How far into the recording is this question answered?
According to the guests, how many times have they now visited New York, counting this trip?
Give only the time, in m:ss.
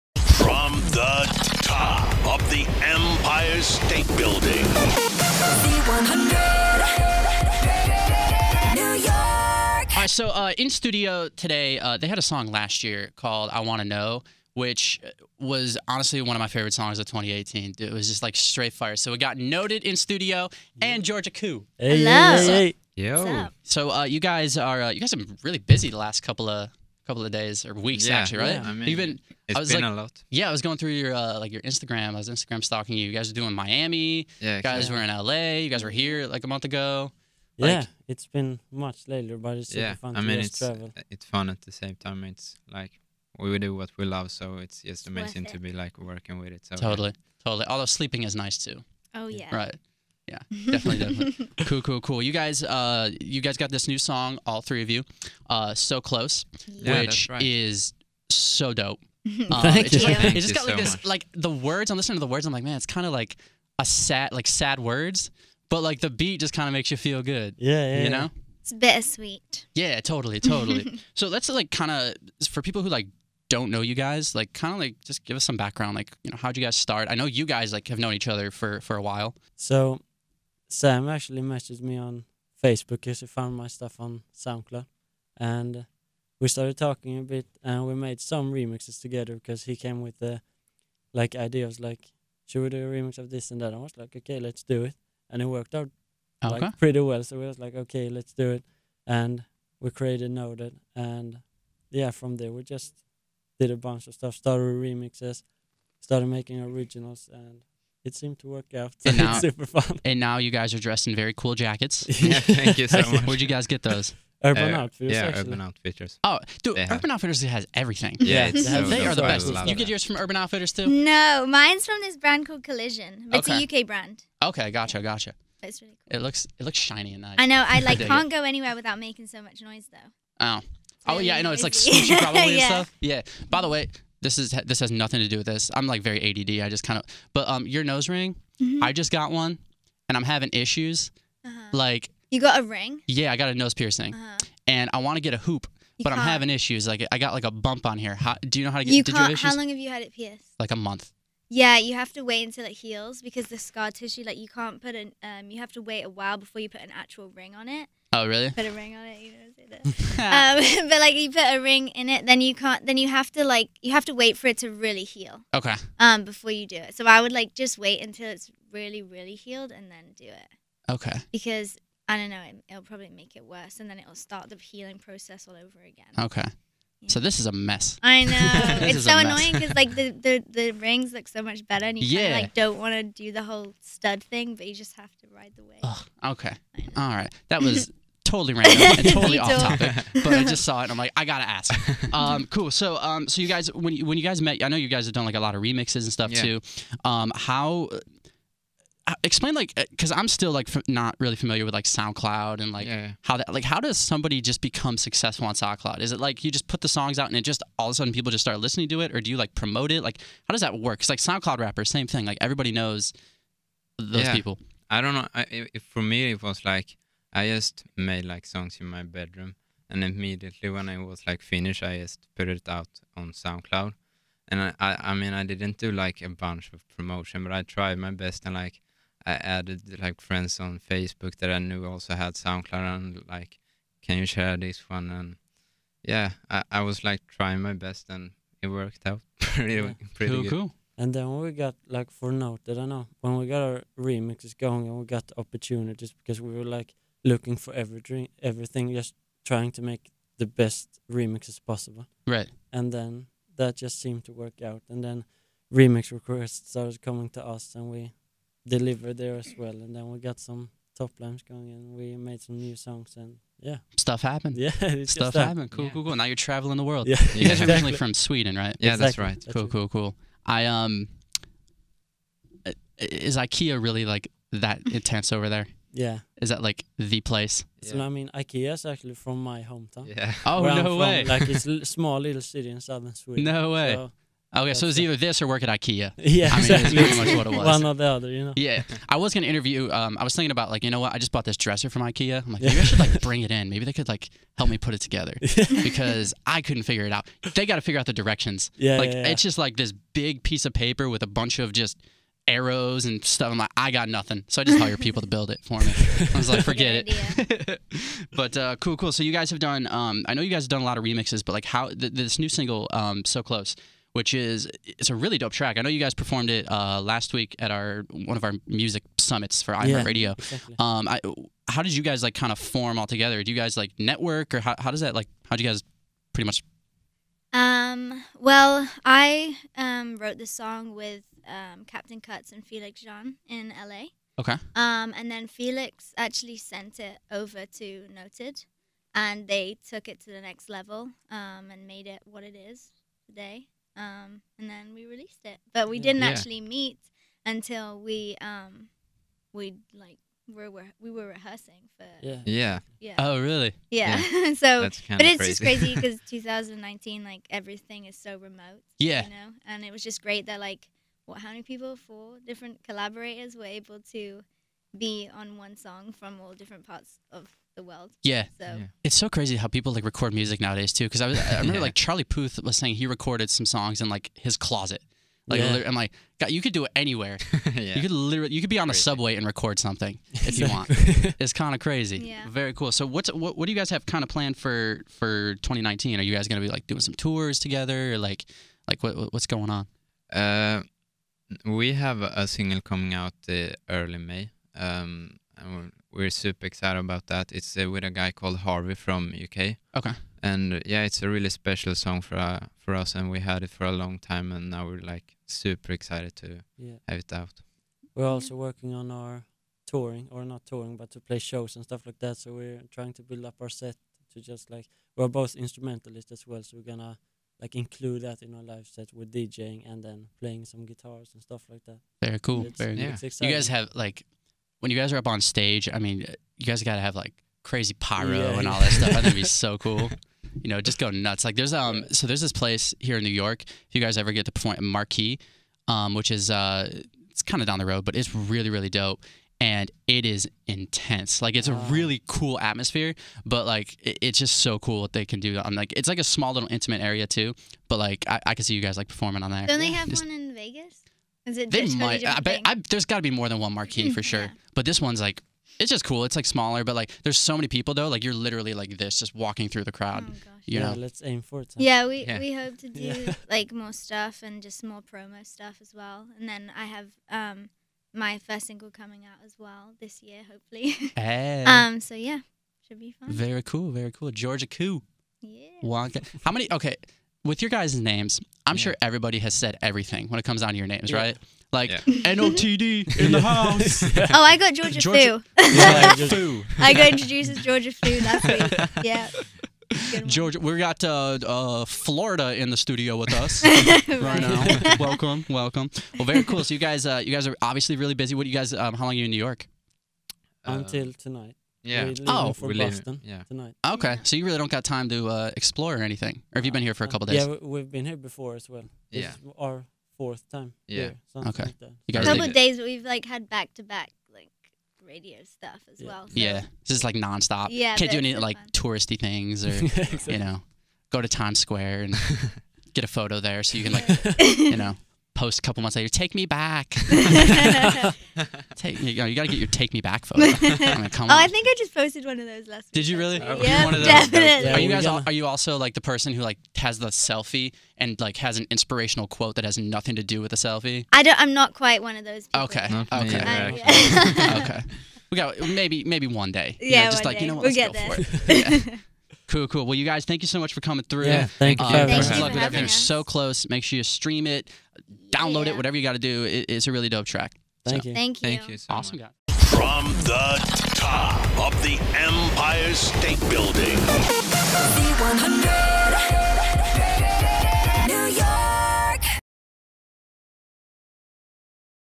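8:30.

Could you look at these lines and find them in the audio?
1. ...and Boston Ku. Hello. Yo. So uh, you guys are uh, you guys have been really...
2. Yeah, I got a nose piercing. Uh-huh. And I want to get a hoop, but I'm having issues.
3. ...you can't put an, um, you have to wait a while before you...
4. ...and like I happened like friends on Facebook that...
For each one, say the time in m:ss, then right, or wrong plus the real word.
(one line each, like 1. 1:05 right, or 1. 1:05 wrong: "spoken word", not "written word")
1. 0:20 wrong: "Georgia", not "Boston"
2. 2:23 right
3. 2:34 right
4. 3:48 wrong: "added", not "happened".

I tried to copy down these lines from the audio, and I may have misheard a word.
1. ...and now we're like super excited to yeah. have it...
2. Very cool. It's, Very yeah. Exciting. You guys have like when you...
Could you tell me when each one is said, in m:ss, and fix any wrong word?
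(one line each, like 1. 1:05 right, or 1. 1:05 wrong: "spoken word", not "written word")
1. 6:44 right
2. 7:02 right.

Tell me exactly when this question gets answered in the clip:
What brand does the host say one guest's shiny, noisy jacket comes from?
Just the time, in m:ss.
2:02.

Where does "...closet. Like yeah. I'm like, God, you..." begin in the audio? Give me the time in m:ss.
6:14.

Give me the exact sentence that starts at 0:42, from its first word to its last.
It's like we do what we love, so it's just amazing it.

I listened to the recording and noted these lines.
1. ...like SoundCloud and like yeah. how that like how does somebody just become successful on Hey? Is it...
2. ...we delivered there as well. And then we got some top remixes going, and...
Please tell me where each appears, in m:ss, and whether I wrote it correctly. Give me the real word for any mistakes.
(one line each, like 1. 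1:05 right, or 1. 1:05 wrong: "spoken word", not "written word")
1. 3:21 wrong: "SoundCloud", not "Hey"
2. 4:17 wrong: "lines", not "remixes".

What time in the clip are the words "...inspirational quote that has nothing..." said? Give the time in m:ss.
8:58.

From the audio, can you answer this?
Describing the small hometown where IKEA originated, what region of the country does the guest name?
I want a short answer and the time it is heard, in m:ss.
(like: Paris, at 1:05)
Southern Sweden, at 4:42.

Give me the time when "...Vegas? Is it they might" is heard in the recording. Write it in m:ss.
7:30.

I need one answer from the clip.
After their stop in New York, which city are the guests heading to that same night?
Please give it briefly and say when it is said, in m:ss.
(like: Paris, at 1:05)
Boston, at 8:22.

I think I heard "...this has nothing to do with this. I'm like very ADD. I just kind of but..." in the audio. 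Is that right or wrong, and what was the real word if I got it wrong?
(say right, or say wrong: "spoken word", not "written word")
right.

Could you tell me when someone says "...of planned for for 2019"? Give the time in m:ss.
6:24.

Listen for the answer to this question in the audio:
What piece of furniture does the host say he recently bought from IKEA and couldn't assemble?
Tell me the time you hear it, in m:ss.
4:51.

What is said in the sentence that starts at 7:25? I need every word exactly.
I'm like, it's like a small little intimate area too.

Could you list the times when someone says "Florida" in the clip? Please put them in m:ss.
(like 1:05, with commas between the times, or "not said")
8:11.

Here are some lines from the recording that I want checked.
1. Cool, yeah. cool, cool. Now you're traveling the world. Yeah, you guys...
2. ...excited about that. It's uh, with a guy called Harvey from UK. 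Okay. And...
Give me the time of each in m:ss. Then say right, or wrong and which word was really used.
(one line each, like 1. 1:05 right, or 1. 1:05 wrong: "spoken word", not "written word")
1. 4:25 right
2. 6:36 right.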